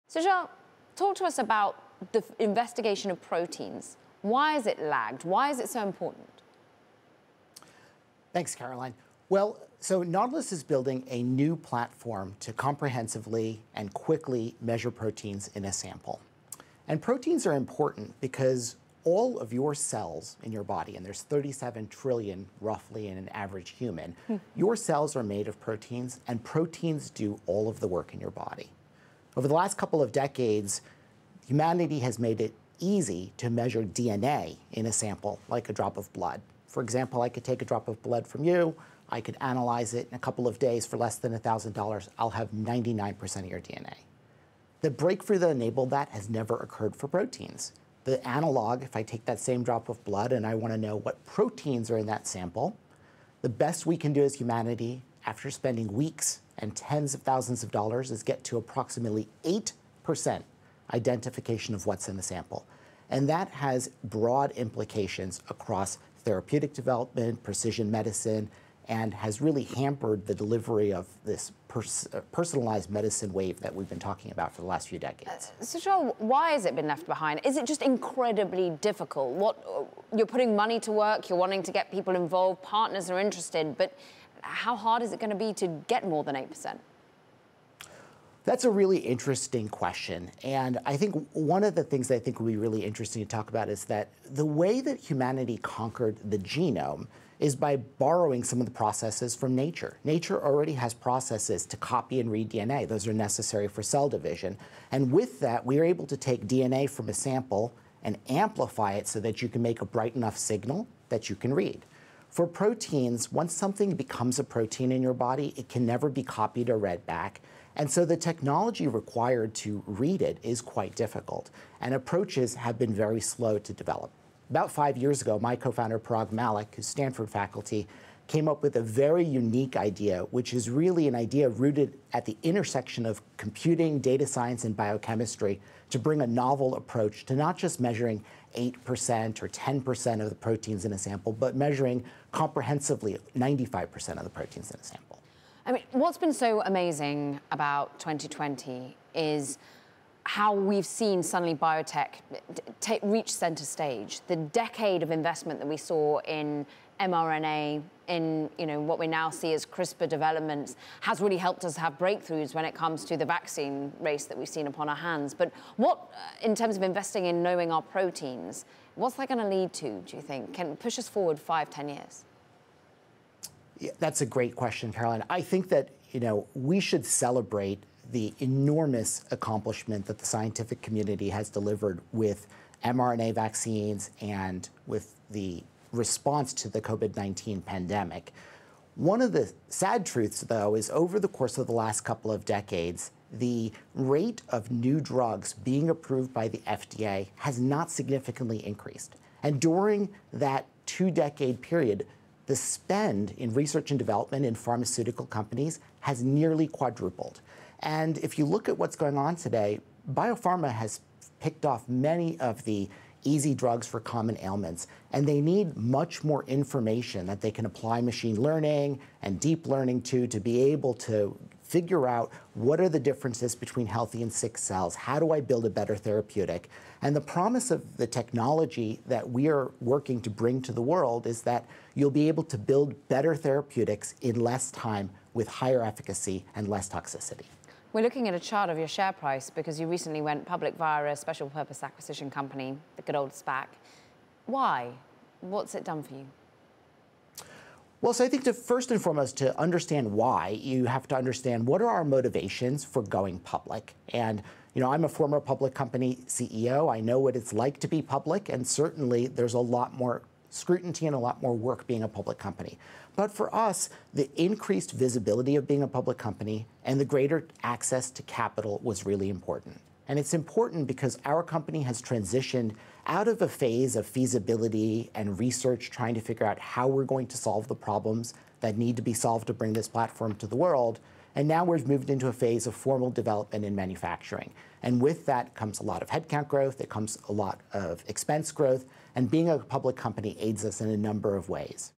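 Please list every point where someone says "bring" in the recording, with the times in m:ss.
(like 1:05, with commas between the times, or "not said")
2:15, 3:50, 4:39.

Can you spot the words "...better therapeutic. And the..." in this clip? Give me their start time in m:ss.
3:45.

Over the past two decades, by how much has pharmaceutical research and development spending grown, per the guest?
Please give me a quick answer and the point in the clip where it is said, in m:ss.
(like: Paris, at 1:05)
nearly quadrupled, at 3:26.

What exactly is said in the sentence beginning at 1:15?
Uh, so, Charles, why has it been left behind?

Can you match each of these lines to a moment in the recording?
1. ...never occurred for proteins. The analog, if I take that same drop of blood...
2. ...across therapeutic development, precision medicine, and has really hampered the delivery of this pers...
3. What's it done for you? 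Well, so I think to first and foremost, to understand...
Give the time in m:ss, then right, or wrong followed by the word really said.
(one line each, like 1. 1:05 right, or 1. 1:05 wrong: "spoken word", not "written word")
1. 0:46 right
2. 1:05 right
3. 4:05 right.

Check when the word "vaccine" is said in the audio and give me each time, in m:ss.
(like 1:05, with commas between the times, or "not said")
2:43, 3:03.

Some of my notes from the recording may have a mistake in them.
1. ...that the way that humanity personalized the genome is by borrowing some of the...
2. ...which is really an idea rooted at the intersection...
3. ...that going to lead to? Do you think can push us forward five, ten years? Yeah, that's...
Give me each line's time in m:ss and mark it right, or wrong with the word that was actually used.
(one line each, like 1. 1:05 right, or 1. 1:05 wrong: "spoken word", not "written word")
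1. 1:33 wrong: "conquered", not "personalized"
2. 2:10 right
3. 2:49 right.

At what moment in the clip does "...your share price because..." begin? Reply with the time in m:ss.
3:58.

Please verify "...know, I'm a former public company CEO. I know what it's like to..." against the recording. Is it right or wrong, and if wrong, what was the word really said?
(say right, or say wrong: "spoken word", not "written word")
right.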